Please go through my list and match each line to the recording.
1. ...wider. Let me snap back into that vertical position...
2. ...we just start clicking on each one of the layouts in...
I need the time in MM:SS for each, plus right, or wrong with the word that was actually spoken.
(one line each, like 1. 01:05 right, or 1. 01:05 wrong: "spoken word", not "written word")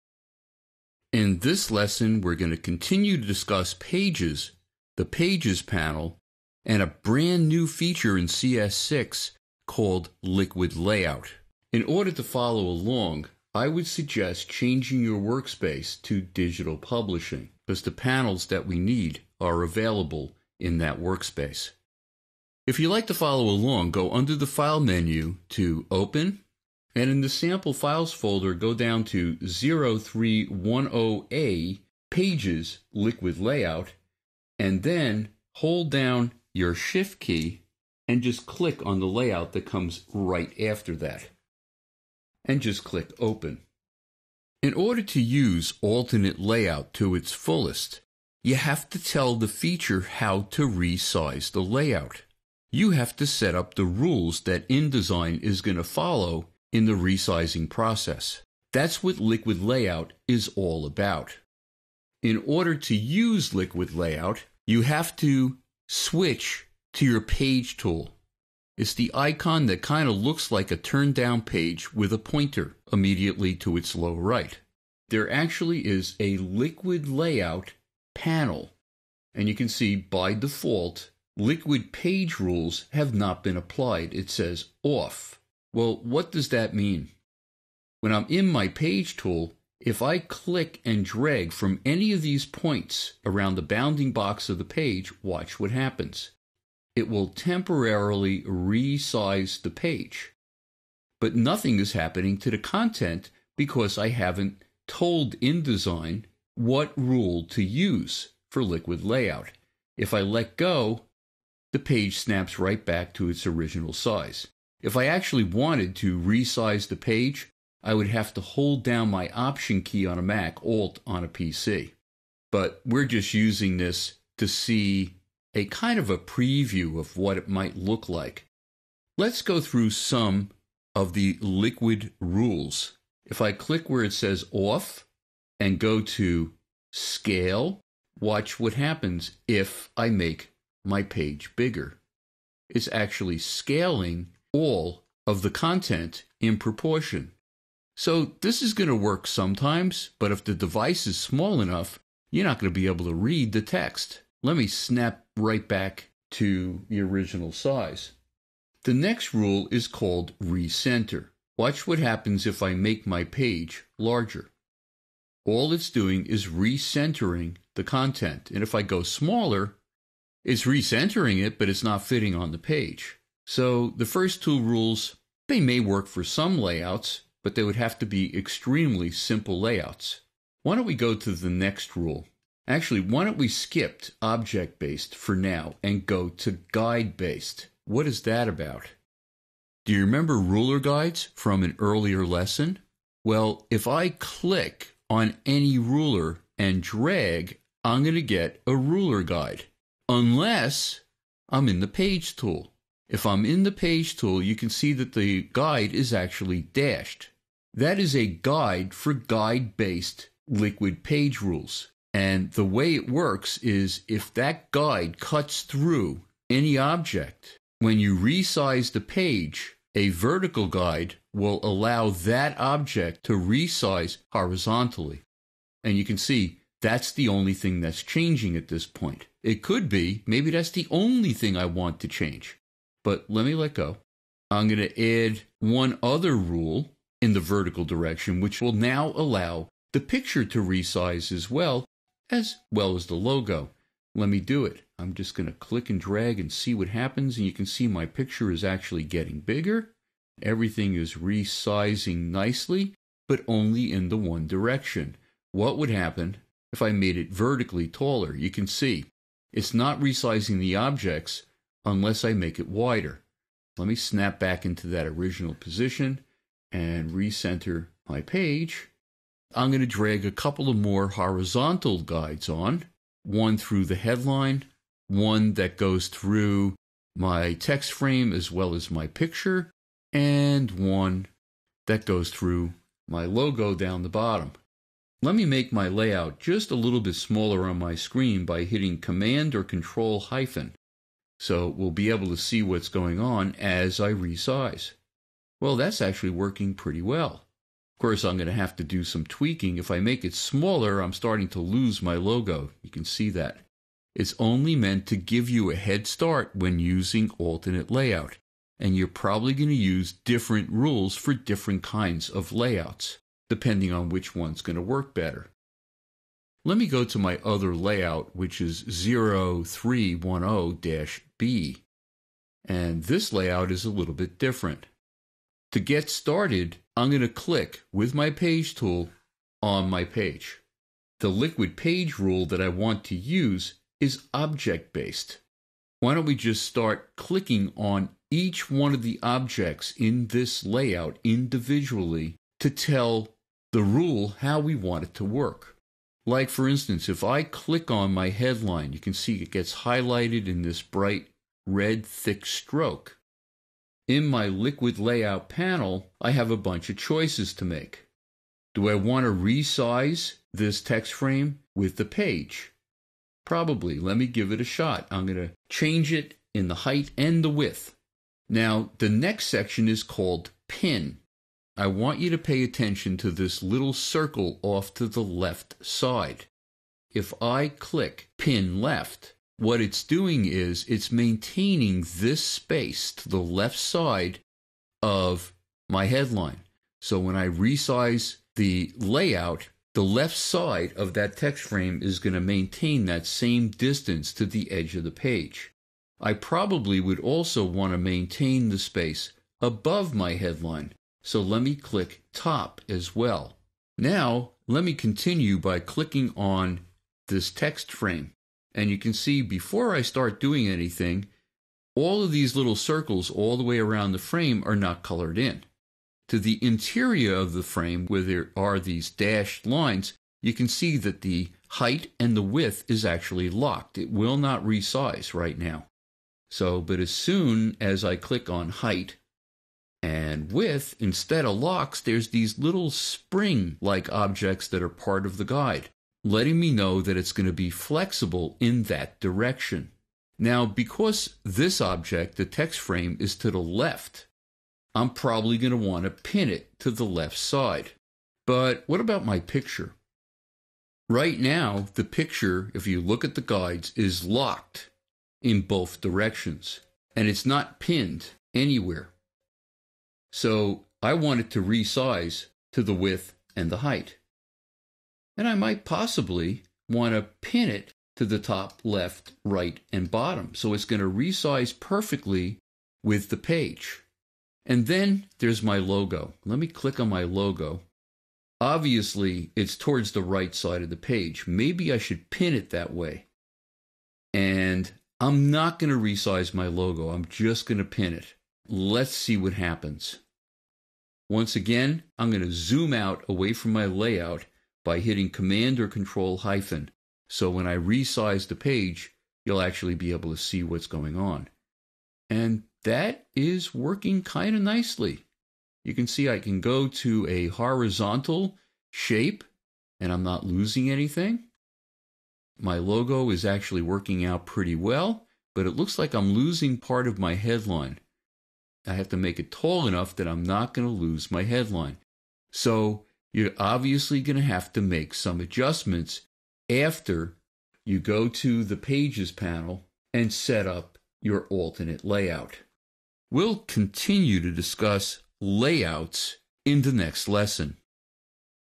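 1. 04:22 wrong: "original", not "vertical"
2. 05:36 wrong: "objects", not "layouts".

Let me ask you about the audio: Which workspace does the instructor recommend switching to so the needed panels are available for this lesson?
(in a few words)
Digital publishing.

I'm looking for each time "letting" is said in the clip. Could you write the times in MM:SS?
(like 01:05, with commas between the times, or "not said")
07:16.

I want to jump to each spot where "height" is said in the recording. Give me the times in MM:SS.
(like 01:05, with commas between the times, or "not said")
06:06, 07:01, 07:08, 07:43.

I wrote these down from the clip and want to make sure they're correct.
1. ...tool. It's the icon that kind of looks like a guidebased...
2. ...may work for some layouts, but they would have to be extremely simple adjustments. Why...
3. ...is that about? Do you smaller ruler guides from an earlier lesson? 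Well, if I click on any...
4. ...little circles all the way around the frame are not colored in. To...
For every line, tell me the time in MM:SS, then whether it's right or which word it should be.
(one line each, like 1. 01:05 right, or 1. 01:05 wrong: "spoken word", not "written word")
1. 01:07 wrong: "turned", not "guidebased"
2. 02:55 wrong: "layouts", not "adjustments"
3. 03:08 wrong: "remember", not "smaller"
4. 06:52 right.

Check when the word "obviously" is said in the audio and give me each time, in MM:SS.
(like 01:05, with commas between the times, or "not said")
07:58, 08:43.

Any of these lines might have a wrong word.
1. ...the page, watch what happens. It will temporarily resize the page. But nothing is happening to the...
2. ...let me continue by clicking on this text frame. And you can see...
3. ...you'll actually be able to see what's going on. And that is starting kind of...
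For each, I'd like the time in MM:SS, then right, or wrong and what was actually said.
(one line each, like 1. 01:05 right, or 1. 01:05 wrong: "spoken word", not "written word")
1. 01:34 right
2. 06:44 right
3. 08:19 wrong: "working", not "starting".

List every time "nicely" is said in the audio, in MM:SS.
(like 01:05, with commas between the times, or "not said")
04:12, 08:24.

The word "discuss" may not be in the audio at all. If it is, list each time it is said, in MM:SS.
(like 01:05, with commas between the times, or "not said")
00:03, 08:54.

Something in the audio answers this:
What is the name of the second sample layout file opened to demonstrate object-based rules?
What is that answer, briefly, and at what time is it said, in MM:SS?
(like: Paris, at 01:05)
0310-B, at 05:18.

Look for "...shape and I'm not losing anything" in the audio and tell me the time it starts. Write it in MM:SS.
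08:28.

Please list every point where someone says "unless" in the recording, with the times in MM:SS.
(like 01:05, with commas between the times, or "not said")
03:20, 04:21.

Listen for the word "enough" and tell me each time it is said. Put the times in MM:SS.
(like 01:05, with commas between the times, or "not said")
02:31, 08:39.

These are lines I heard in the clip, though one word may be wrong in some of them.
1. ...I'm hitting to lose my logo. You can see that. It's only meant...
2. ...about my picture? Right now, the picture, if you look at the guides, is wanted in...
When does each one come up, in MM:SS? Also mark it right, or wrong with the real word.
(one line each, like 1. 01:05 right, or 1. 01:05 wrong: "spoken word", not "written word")
1. 05:00 wrong: "starting", not "hitting"
2. 07:28 wrong: "locked", not "wanted".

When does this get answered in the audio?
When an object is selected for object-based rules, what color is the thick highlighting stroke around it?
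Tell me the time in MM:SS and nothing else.
05:50.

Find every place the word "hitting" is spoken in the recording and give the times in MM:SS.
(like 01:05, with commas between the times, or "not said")
04:48, 08:14.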